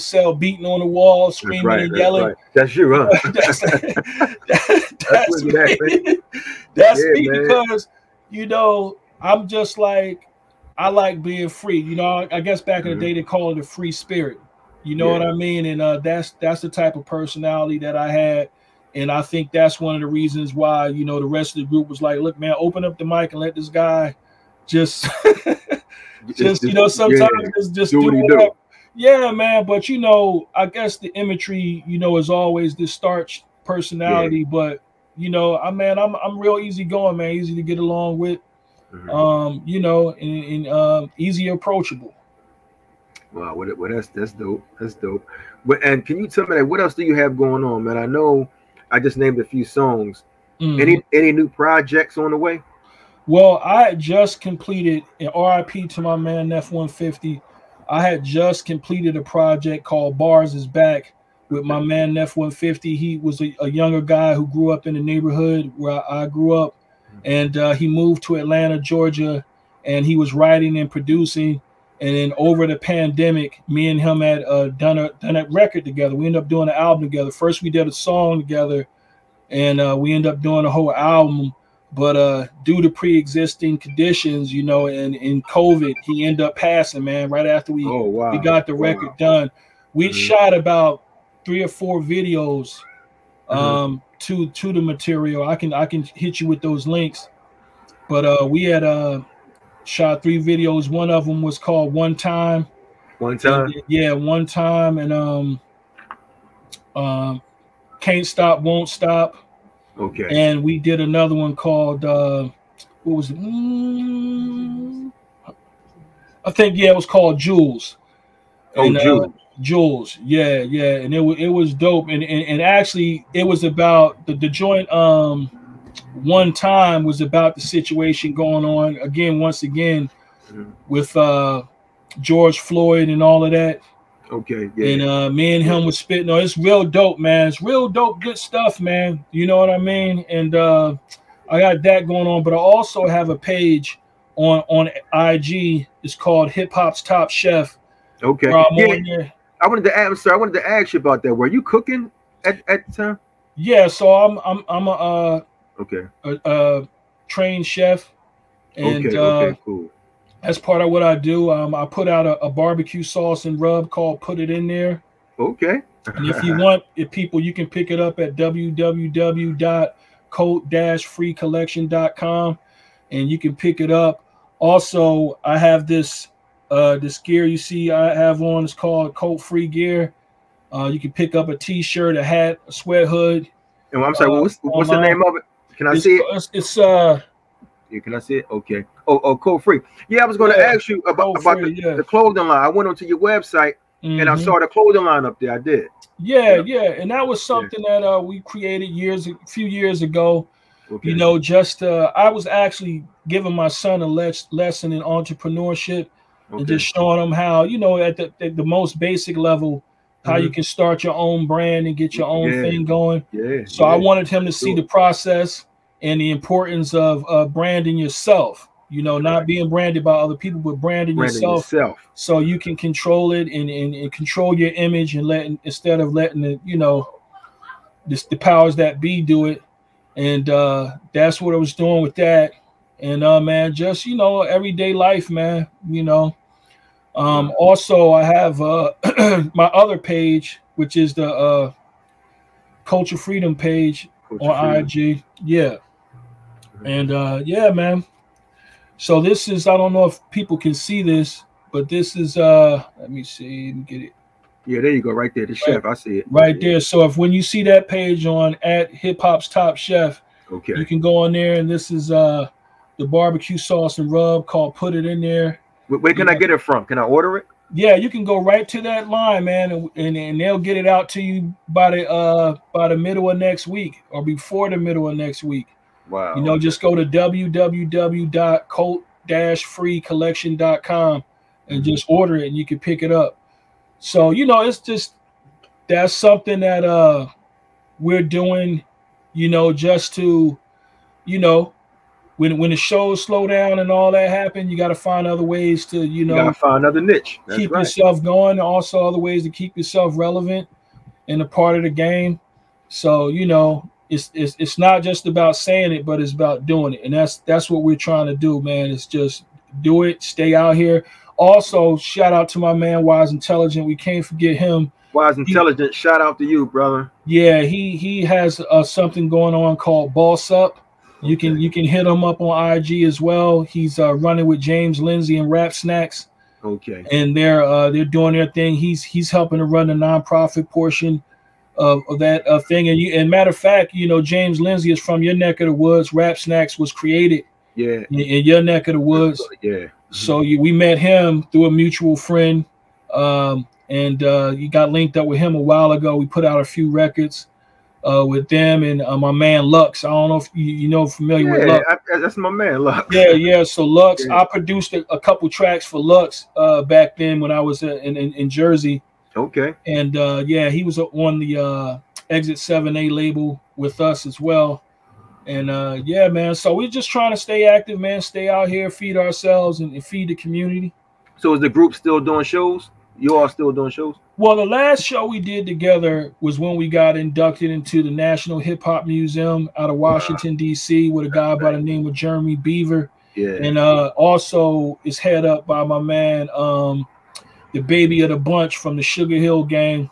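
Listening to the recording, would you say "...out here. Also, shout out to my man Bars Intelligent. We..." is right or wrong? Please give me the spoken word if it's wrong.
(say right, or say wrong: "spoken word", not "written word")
wrong: "Wise", not "Bars".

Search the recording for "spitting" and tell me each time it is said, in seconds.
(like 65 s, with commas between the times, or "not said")
135 s.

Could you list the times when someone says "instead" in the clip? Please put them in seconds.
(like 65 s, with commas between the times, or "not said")
225 s.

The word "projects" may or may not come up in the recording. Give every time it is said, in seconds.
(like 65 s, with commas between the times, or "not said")
51 s, 59 s.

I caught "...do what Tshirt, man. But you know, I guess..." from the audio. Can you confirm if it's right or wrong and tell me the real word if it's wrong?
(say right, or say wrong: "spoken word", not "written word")
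wrong: "Yeah", not "Tshirt".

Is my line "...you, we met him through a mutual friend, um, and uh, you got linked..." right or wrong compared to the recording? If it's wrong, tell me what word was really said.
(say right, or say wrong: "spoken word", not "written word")
right.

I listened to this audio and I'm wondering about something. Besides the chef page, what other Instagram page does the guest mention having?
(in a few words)
Culture Freedom.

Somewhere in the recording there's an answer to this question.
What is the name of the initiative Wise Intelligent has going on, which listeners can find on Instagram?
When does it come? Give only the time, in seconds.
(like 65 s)
320 s.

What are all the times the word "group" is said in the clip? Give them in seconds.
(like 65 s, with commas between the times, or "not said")
21 s, 371 s.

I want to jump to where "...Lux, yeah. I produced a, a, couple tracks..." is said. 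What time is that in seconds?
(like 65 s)
353 s.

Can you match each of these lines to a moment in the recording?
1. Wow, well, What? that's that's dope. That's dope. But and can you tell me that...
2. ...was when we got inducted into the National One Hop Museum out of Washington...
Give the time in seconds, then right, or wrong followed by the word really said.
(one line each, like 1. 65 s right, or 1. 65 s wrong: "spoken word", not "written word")
1. 43 s right
2. 376 s wrong: "Hip", not "One".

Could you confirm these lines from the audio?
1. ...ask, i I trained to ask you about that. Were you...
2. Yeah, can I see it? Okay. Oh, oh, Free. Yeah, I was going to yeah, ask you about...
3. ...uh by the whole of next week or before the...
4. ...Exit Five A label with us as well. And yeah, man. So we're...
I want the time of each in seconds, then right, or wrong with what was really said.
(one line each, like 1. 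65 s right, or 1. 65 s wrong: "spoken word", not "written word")
1. 149 s wrong: "wanted", not "trained"
2. 187 s right
3. 272 s wrong: "middle", not "whole"
4. 362 s wrong: "Seven", not "Five".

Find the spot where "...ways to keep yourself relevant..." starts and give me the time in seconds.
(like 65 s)
299 s.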